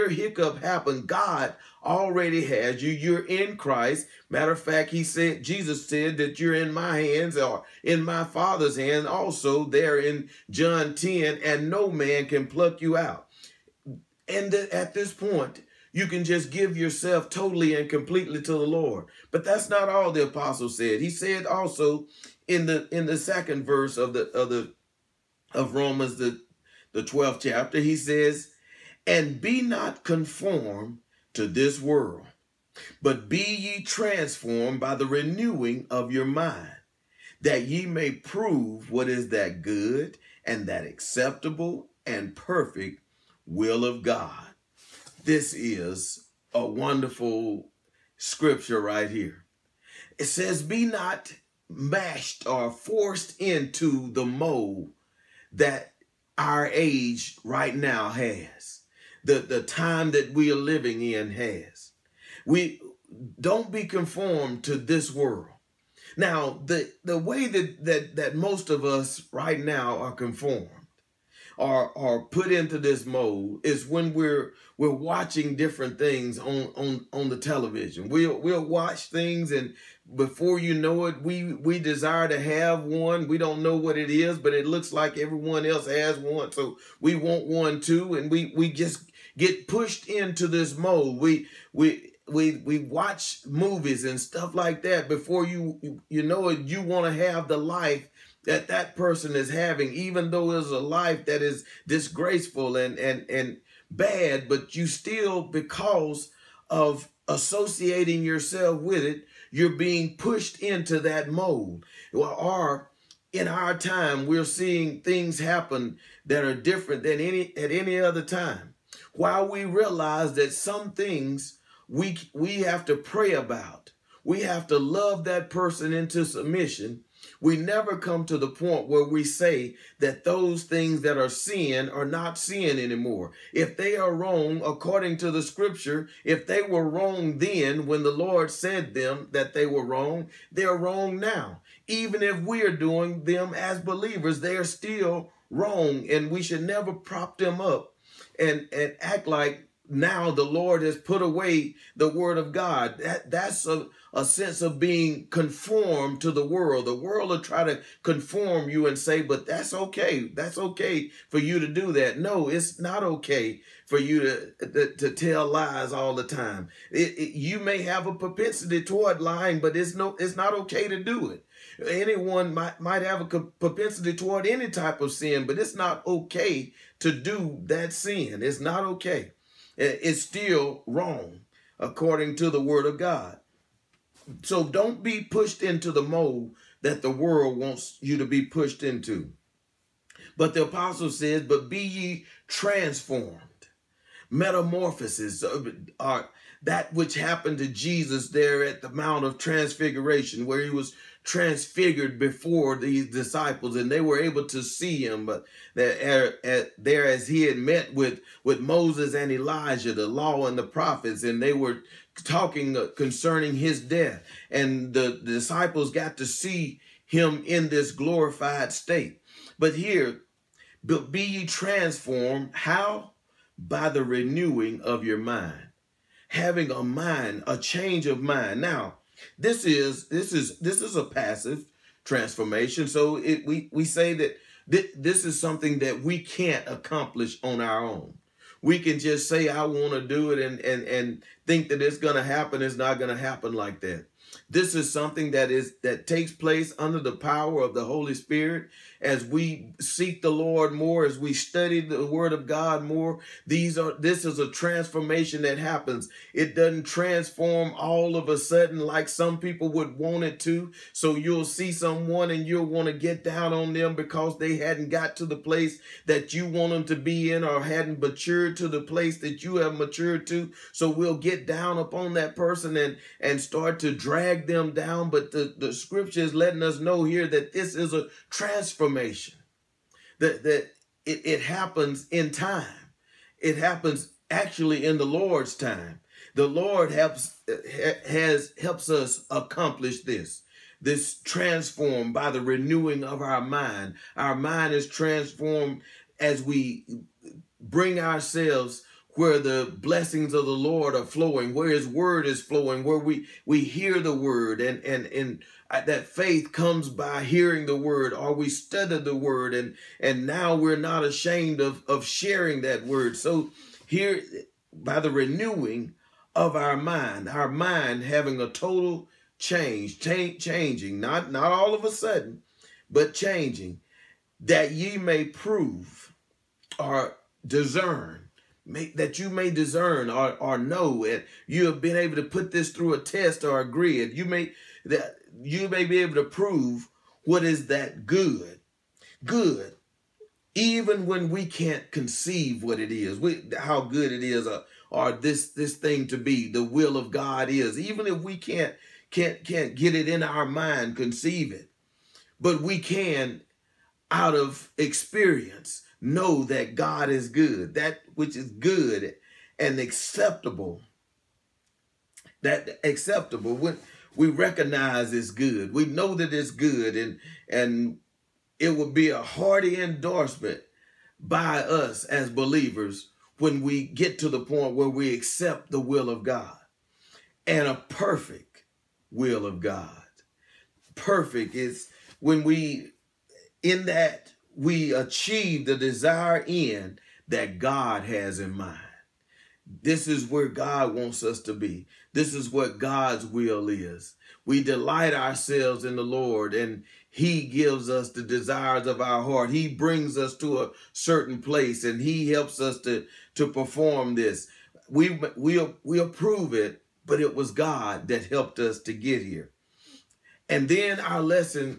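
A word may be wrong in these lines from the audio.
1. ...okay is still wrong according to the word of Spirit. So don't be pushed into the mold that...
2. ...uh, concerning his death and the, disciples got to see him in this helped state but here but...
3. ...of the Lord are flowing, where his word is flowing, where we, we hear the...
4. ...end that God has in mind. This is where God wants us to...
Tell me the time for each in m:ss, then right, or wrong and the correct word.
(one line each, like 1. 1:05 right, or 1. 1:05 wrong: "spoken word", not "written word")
1. 2:58 wrong: "God", not "Spirit"
2. 3:32 wrong: "glorified", not "helped"
3. 5:00 right
4. 6:26 right.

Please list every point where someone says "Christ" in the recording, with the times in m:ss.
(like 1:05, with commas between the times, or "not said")
0:03.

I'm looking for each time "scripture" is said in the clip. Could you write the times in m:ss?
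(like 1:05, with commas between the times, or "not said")
0:48, 2:15, 4:35.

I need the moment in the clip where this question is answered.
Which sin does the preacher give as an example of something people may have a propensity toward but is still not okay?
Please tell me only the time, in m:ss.
2:49.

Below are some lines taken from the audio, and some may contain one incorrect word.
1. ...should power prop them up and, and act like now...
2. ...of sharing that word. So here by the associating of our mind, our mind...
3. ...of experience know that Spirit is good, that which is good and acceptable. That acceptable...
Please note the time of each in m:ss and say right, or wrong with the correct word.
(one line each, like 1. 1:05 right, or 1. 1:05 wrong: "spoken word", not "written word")
1. 2:26 wrong: "never", not "power"
2. 5:11 wrong: "renewing", not "associating"
3. 5:54 wrong: "God", not "Spirit".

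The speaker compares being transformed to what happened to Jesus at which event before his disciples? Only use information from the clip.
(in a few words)
Mount of Transfiguration.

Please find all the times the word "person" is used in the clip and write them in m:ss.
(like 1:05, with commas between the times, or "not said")
1:38, 2:05, 4:32.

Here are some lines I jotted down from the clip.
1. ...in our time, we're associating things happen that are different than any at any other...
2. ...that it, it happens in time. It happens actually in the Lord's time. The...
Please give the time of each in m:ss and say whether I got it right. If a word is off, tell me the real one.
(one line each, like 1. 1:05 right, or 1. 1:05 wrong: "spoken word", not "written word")
1. 1:53 wrong: "seeing", not "associating"
2. 4:40 right.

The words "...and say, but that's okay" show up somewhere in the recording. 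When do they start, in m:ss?
2:38.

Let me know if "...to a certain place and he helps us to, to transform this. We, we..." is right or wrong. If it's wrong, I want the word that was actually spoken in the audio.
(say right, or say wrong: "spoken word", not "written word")
wrong: "perform", not "transform".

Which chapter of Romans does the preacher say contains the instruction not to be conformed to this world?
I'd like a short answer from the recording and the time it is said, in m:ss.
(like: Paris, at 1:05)
12th, at 0:27.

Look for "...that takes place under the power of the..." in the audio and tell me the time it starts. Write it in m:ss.
4:05.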